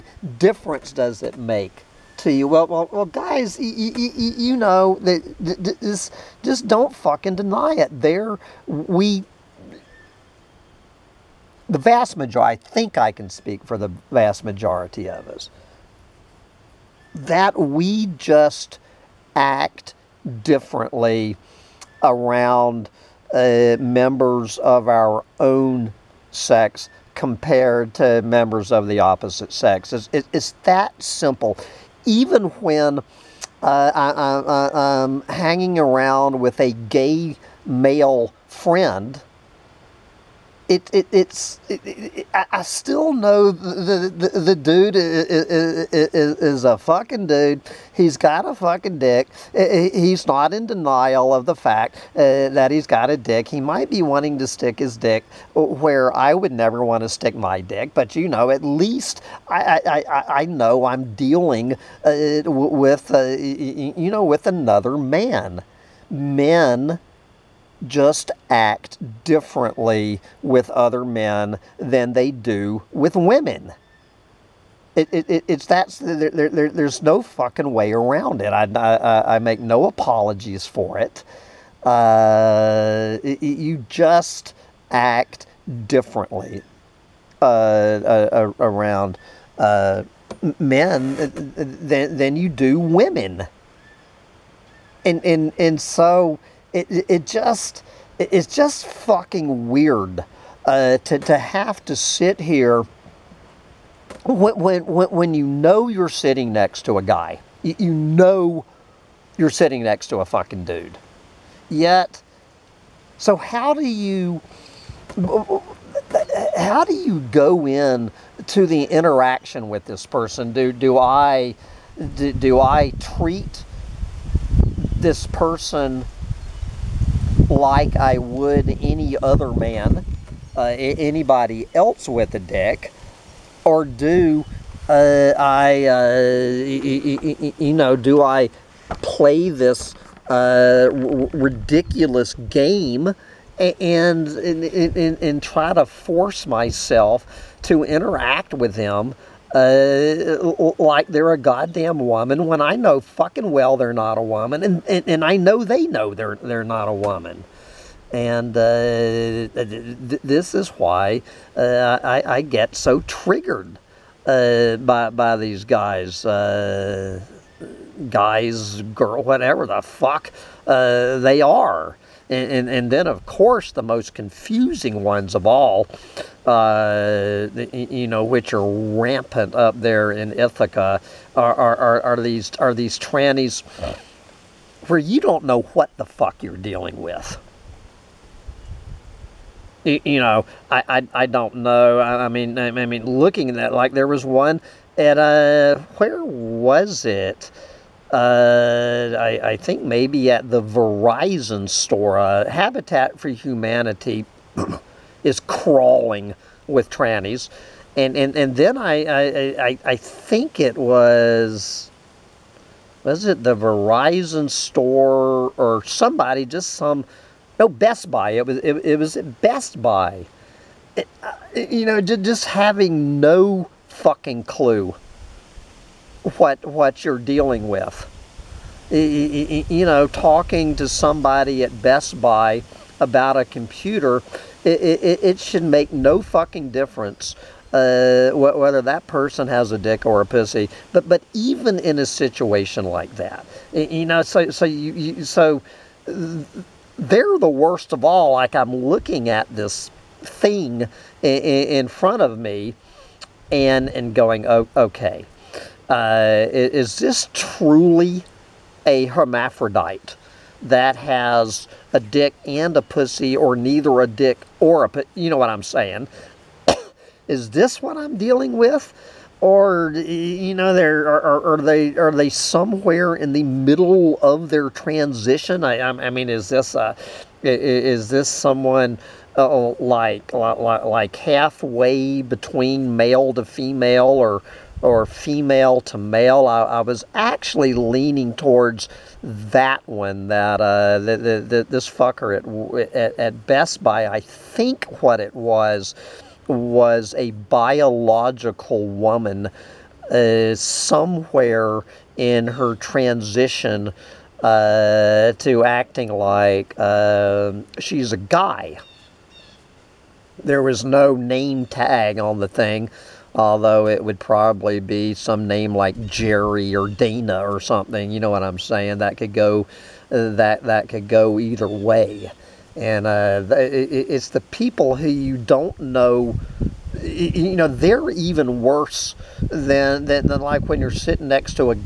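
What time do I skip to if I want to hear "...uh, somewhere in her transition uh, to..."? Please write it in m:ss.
5:00.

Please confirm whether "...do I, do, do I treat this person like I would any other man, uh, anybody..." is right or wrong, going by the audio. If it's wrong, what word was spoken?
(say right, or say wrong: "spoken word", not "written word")
right.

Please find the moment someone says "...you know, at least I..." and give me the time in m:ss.
0:58.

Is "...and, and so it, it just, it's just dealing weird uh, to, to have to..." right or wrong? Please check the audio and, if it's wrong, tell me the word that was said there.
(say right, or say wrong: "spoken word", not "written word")
wrong: "fucking", not "dealing".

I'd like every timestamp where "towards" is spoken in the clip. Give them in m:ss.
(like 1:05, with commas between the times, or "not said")
4:48.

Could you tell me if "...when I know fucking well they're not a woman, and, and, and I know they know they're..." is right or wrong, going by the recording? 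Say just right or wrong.
right.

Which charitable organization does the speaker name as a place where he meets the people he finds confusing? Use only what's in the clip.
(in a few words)
Habitat for Humanity.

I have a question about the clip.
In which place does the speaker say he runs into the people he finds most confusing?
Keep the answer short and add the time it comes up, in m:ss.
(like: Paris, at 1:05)
Ithaca, at 3:00.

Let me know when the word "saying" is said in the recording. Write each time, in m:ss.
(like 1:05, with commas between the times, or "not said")
4:25, 5:18.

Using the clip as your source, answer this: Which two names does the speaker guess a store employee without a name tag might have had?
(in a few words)
Jerry or Dana.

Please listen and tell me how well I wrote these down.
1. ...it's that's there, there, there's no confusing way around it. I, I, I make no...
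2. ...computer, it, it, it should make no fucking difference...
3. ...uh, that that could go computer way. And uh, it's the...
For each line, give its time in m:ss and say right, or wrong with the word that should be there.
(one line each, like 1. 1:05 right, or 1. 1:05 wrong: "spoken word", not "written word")
1. 1:15 wrong: "fucking", not "confusing"
2. 3:53 right
3. 5:20 wrong: "either", not "computer".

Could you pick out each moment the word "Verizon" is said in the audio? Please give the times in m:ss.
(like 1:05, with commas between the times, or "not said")
3:20, 3:33.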